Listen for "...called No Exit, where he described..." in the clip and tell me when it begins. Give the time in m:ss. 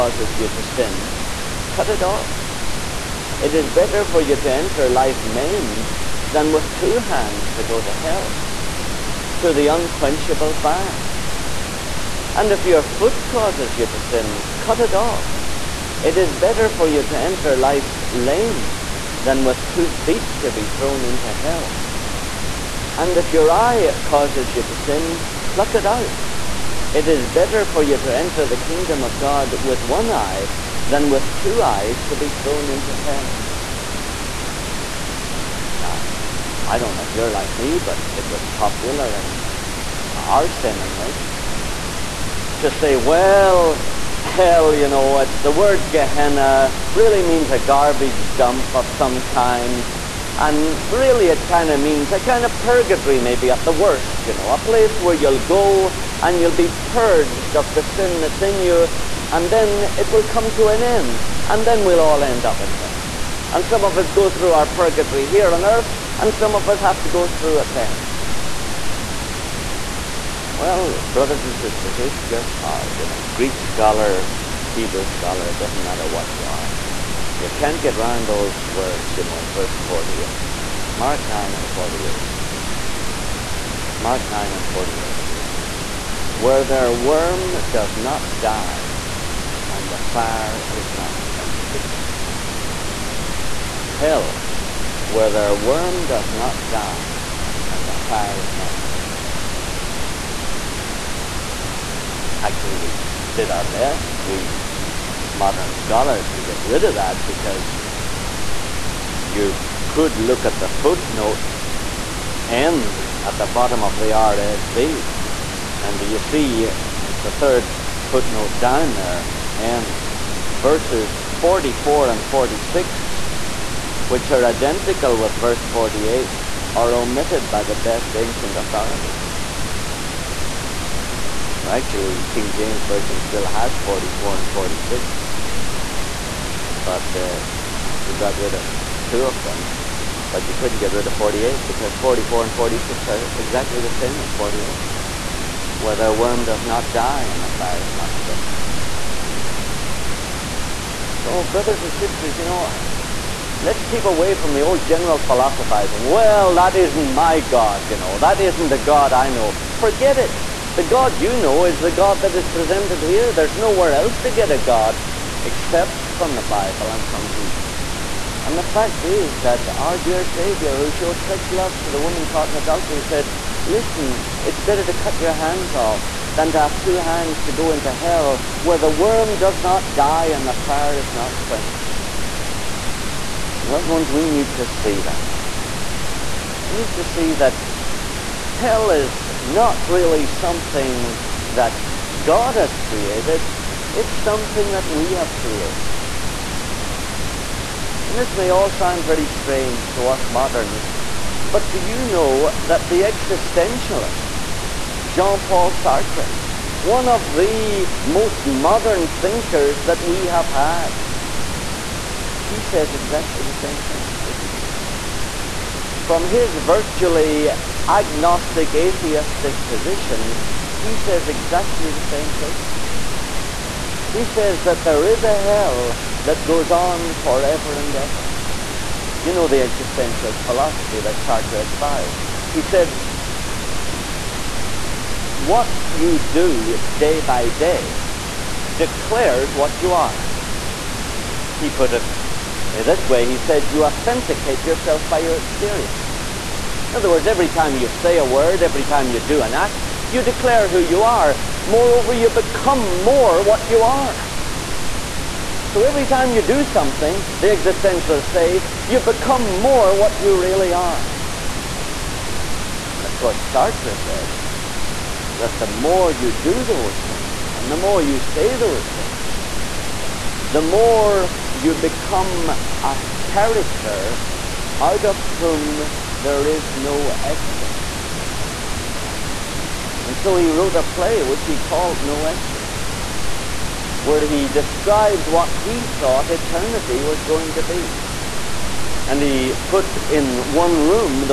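4:41.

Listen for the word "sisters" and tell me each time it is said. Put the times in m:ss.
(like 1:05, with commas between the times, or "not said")
1:11, 2:31.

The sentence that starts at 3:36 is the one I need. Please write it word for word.
From his virtually agnostic, atheistic position, he says exactly the same thing.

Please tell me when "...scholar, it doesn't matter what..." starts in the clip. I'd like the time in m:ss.
1:15.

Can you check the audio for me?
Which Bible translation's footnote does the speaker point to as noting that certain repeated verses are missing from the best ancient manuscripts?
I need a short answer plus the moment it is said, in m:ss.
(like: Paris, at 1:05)
RSV, at 1:54.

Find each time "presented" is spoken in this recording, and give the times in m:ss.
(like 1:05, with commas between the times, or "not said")
2:42.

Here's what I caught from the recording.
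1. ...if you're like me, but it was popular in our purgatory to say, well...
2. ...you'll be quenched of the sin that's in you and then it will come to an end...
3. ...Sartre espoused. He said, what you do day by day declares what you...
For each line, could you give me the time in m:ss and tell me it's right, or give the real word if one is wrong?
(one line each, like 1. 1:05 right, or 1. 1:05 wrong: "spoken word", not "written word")
1. 0:37 wrong: "seminary", not "purgatory"
2. 0:56 wrong: "purged", not "quenched"
3. 3:51 right.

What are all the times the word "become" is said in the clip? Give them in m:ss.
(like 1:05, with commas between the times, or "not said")
4:12, 4:19, 4:31.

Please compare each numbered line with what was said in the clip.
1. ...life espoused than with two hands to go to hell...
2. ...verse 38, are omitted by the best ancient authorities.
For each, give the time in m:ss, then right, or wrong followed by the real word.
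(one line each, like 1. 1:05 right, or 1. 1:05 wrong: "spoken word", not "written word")
1. 0:04 wrong: "maimed", not "espoused"
2. 2:05 wrong: "48", not "38".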